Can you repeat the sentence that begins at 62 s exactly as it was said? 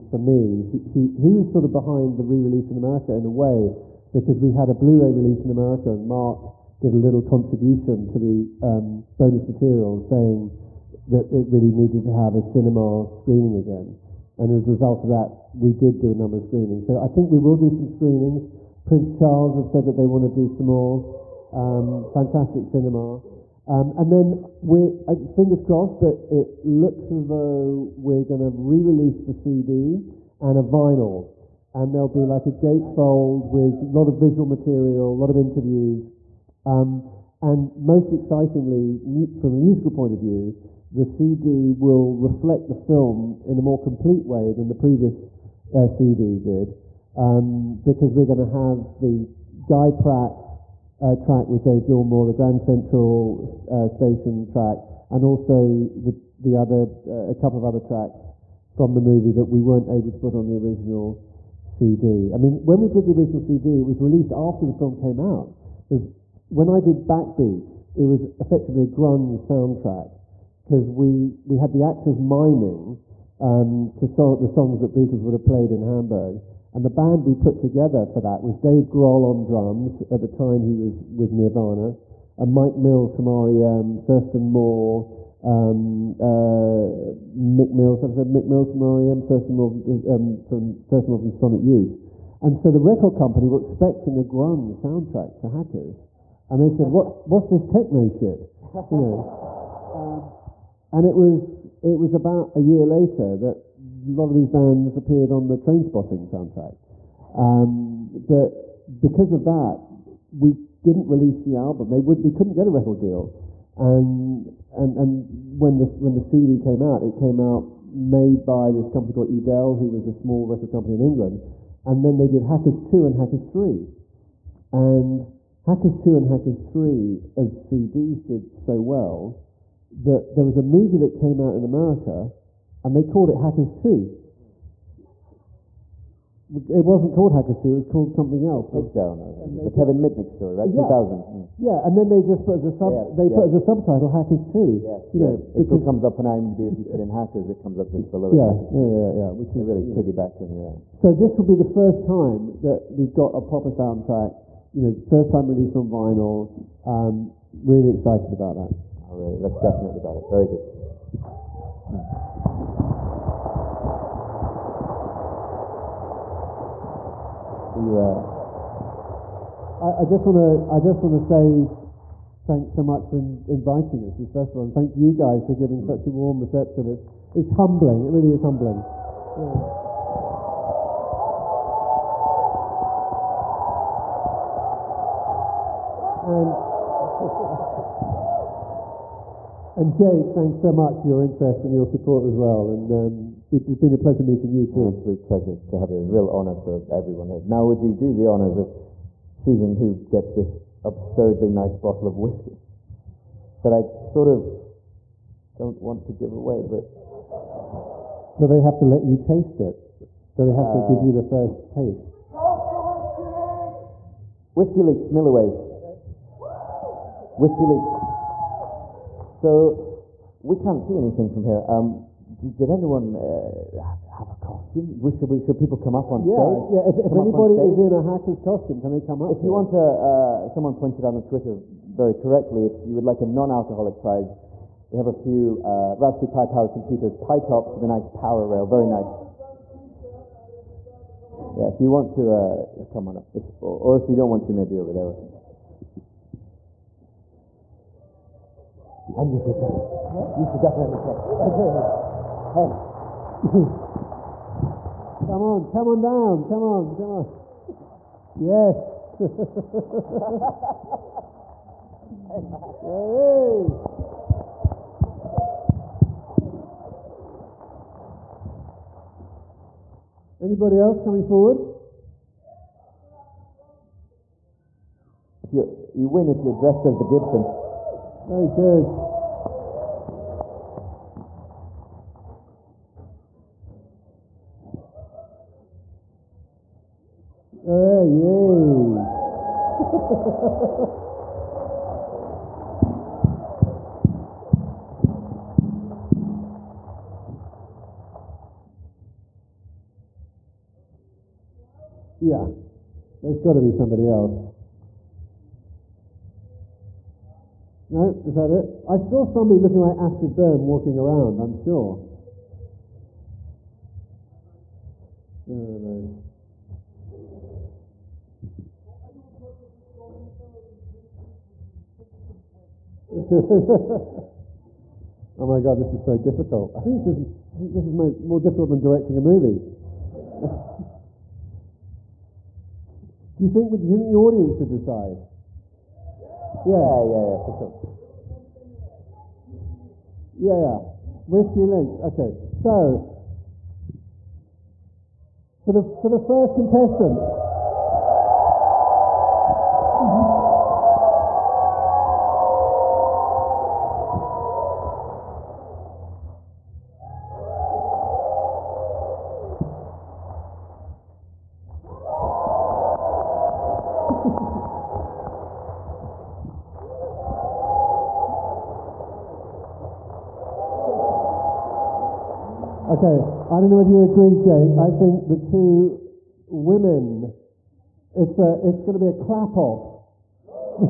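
I mean, when we did the original CD, it was released after the film came out.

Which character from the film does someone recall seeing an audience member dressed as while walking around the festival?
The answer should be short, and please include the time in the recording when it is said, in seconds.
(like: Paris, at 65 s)
Acid Burn, at 309 s.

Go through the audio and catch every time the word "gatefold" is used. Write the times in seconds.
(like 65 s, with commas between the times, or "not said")
32 s.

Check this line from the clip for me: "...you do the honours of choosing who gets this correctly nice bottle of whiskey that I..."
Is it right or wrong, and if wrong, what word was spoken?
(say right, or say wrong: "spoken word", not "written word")
wrong: "absurdly", not "correctly".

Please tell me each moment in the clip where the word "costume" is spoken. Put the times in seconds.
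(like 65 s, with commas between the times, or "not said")
224 s, 228 s.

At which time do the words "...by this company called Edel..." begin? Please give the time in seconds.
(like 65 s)
118 s.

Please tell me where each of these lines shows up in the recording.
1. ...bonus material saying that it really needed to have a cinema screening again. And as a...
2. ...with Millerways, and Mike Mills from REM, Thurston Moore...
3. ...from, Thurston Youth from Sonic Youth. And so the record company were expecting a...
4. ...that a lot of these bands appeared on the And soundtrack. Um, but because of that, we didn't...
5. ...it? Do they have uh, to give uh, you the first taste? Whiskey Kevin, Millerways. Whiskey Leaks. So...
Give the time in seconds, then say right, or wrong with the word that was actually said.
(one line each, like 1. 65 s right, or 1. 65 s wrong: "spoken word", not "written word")
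1. 9 s right
2. 81 s wrong: "Nirvana", not "Millerways"
3. 90 s wrong: "Moore", not "Youth"
4. 103 s wrong: "Trainspotting", not "And"
5. 209 s wrong: "Leaks", not "Kevin".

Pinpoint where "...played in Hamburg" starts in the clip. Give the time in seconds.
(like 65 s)
75 s.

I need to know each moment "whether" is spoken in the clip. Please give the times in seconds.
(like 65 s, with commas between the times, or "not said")
373 s.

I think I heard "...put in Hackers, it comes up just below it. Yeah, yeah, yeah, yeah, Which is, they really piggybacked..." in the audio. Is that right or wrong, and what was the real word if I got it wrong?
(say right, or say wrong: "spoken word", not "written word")
right.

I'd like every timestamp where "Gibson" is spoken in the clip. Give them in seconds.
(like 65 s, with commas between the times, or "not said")
277 s.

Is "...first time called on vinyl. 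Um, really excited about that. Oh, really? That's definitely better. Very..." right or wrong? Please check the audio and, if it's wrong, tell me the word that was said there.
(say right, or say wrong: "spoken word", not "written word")
wrong: "released", not "called".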